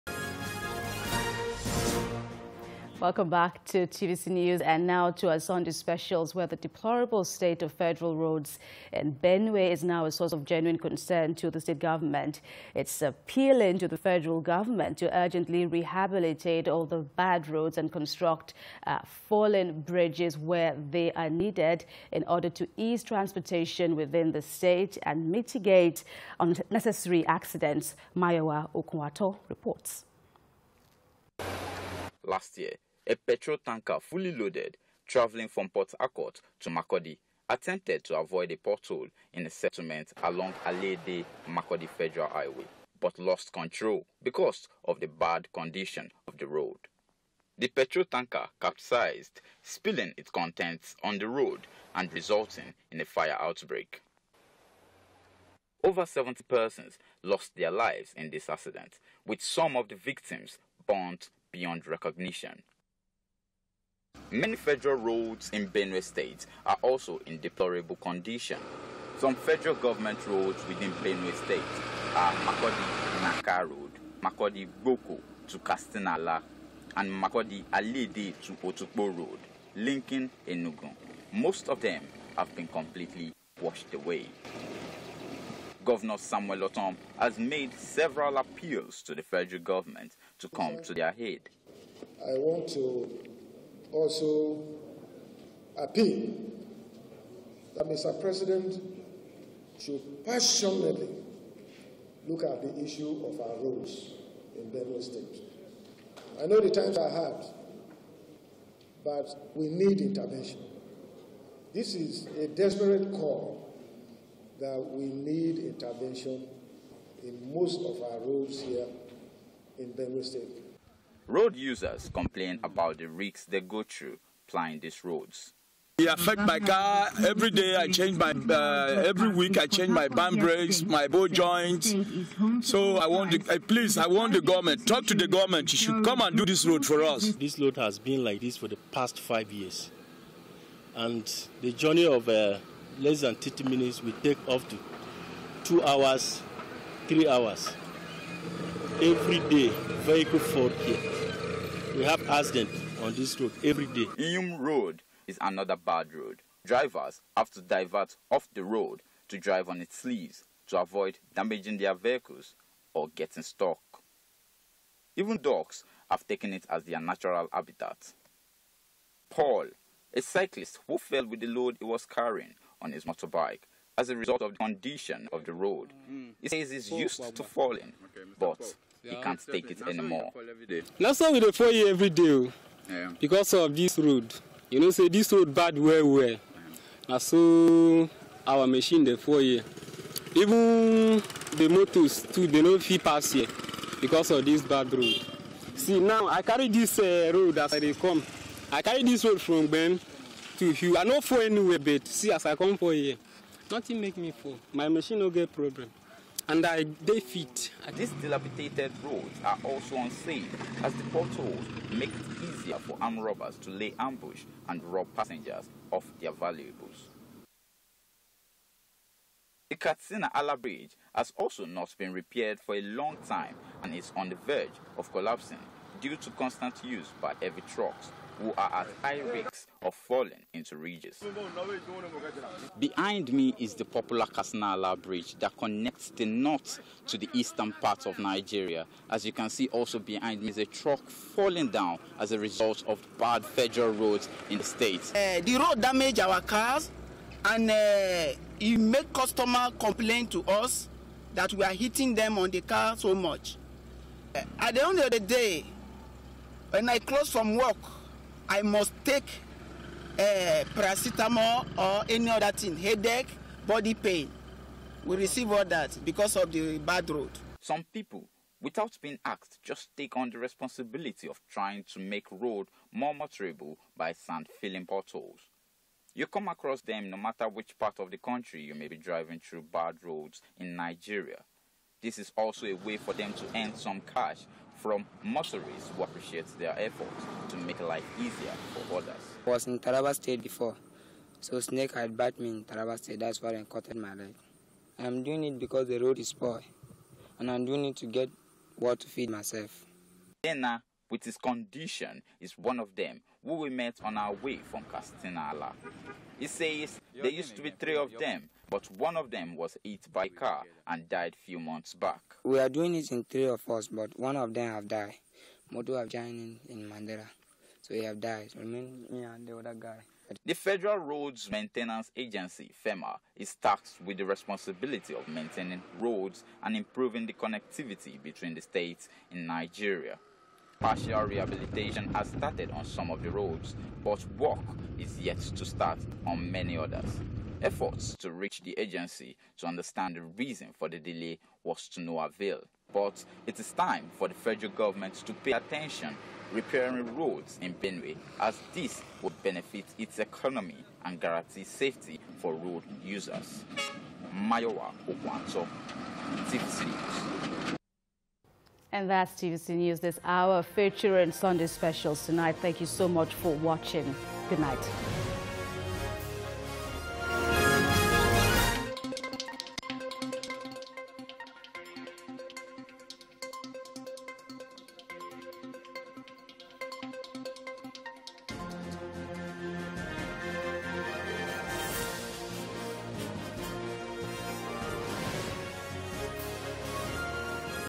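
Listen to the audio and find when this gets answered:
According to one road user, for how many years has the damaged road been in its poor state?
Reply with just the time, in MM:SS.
02:19.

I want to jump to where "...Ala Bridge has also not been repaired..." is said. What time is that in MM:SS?
03:40.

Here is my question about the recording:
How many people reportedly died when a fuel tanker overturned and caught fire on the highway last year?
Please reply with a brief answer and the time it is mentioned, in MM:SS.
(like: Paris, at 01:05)
Over 70, at 00:55.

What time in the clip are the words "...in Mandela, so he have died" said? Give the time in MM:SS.
05:16.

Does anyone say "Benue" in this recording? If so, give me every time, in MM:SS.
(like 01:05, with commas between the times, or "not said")
00:09, 01:05, 01:11, 01:44, 01:59, 05:47.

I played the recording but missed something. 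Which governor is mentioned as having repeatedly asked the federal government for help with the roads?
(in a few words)
Samuel Ortom.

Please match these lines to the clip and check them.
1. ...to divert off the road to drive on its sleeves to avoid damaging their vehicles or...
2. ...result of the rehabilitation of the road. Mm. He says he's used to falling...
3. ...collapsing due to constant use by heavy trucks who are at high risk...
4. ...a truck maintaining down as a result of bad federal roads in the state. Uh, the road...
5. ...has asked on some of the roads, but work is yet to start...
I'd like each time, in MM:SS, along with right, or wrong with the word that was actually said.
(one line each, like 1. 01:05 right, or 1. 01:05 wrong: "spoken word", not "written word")
1. 02:37 right
2. 02:54 wrong: "condition", not "rehabilitation"
3. 03:45 right
4. 04:00 wrong: "falling", not "maintaining"
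5. 05:32 wrong: "started", not "asked".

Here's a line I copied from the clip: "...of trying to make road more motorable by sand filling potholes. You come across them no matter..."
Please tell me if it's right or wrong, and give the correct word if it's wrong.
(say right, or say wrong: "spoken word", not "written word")
right.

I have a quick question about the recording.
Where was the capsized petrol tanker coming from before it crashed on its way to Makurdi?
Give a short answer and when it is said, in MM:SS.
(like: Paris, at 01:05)
Port Harcourt, at 00:35.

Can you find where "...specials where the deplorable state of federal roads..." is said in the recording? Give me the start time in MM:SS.
00:05.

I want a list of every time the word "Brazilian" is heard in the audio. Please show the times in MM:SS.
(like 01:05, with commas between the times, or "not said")
not said.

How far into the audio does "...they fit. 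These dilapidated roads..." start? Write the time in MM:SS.
03:27.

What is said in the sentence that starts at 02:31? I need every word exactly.
We have accidents on this road every day.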